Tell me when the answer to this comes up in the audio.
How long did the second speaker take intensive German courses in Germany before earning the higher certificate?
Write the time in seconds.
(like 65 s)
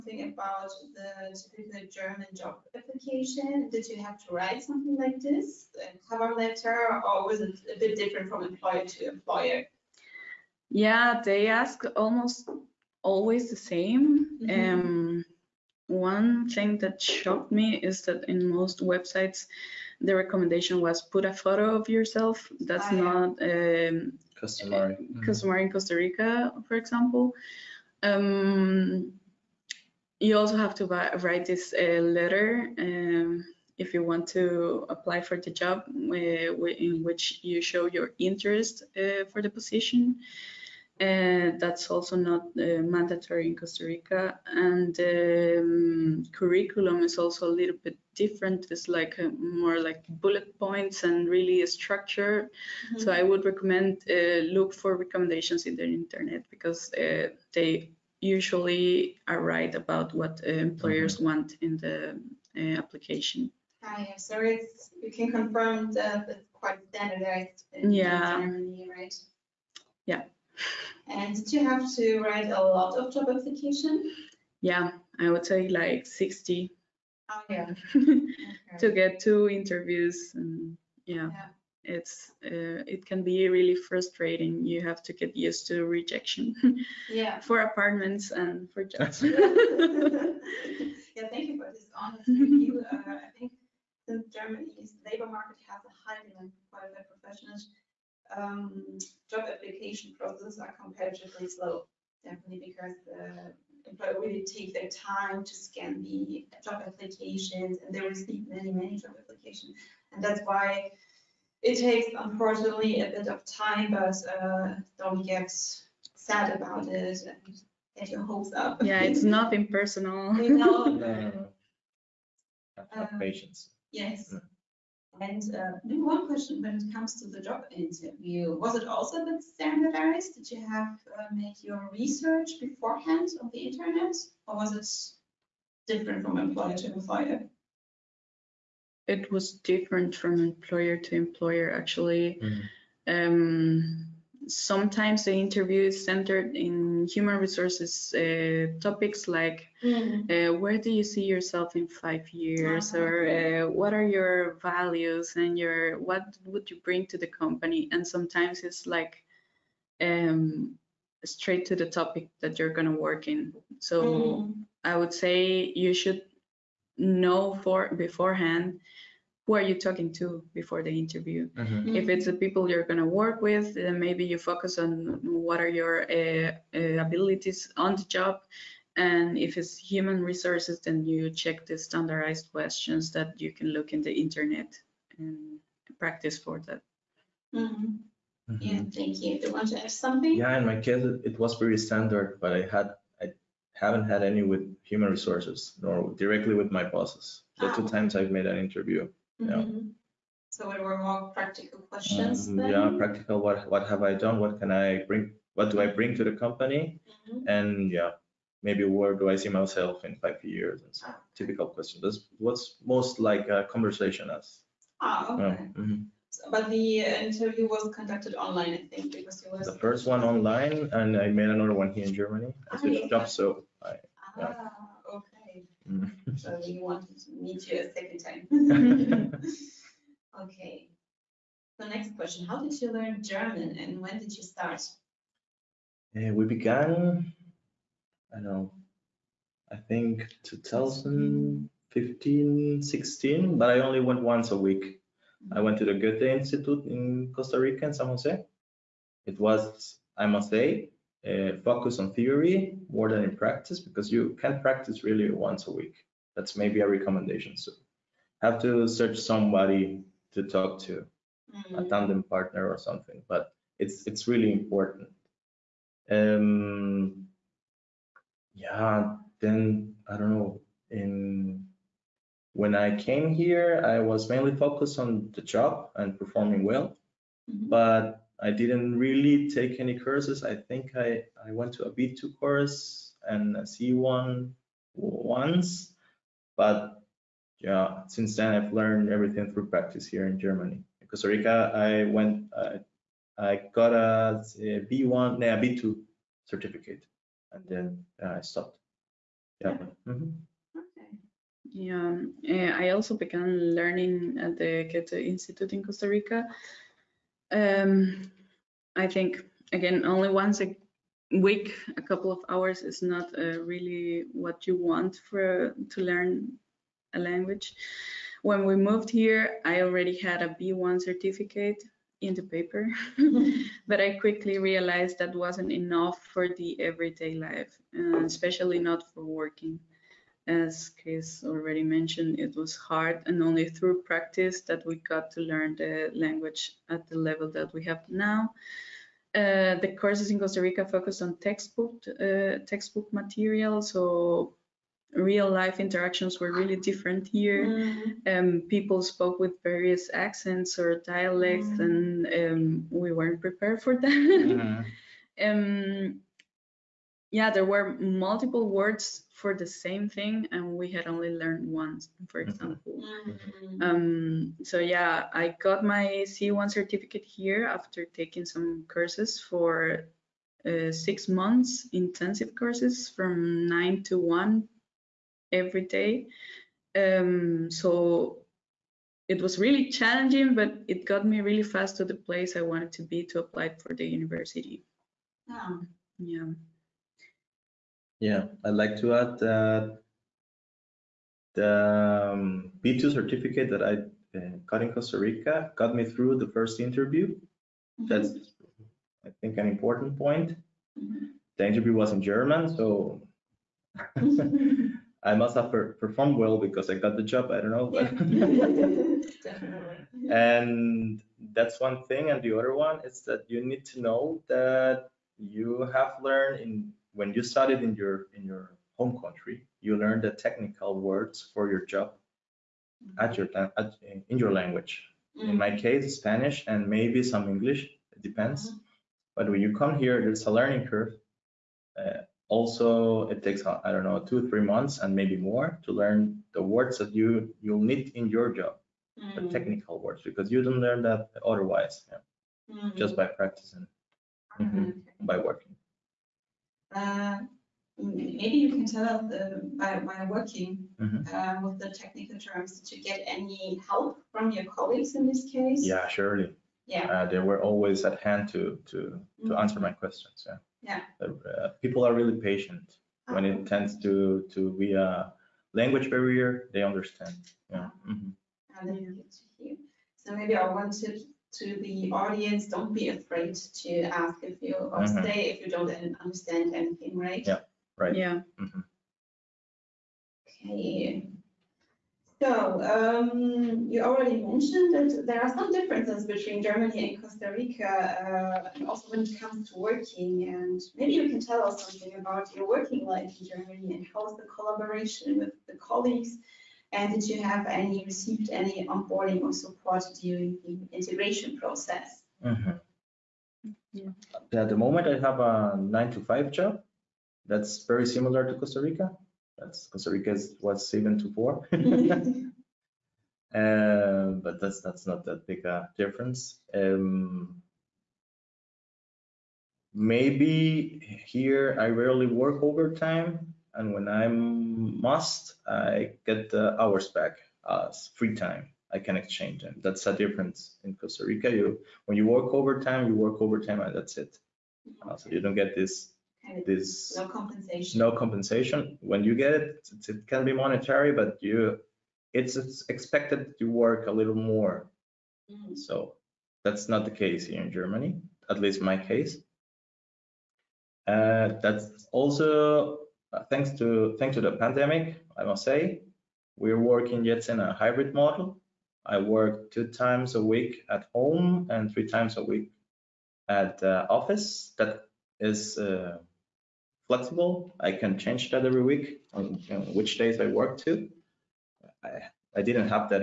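370 s.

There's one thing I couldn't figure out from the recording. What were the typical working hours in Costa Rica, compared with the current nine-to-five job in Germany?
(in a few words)
7 to 4.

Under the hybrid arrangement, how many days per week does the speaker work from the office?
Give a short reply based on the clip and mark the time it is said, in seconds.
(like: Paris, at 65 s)
3, at 561 s.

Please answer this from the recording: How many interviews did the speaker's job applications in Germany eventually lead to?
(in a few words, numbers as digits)
2.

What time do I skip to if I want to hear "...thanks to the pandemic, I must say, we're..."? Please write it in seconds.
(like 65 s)
554 s.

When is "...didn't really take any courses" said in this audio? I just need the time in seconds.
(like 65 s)
278 s.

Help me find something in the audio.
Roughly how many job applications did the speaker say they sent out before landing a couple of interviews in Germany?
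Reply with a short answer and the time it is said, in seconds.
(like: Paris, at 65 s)
60, at 76 s.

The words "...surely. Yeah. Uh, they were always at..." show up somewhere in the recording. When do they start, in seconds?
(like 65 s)
456 s.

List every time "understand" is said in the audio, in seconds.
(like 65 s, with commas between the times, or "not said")
466 s, 476 s.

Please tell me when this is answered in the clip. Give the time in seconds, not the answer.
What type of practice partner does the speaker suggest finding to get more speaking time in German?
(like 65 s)
261 s.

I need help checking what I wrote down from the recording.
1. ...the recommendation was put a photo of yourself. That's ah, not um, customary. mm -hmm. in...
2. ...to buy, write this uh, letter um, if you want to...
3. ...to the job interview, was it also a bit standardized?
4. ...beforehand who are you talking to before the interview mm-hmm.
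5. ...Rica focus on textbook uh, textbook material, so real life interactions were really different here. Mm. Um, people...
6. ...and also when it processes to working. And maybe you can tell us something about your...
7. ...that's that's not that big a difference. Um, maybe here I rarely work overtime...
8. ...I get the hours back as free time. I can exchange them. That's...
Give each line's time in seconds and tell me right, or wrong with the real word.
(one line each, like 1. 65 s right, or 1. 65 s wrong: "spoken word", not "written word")
1. 20 s right
2. 30 s right
3. 127 s right
4. 167 s right
5. 340 s right
6. 488 s wrong: "comes", not "processes"
7. 514 s right
8. 525 s right.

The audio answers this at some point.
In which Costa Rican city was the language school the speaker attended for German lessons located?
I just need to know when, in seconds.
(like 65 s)
247 s.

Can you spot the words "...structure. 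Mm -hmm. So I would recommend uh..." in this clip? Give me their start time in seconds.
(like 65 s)
51 s.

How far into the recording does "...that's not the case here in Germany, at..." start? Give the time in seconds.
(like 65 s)
546 s.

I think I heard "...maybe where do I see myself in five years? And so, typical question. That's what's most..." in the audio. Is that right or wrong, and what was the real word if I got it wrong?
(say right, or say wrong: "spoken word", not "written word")
right.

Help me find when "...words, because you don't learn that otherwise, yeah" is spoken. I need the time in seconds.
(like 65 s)
440 s.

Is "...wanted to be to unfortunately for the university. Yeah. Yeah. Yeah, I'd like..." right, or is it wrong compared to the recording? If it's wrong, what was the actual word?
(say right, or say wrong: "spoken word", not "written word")
wrong: "apply", not "unfortunately".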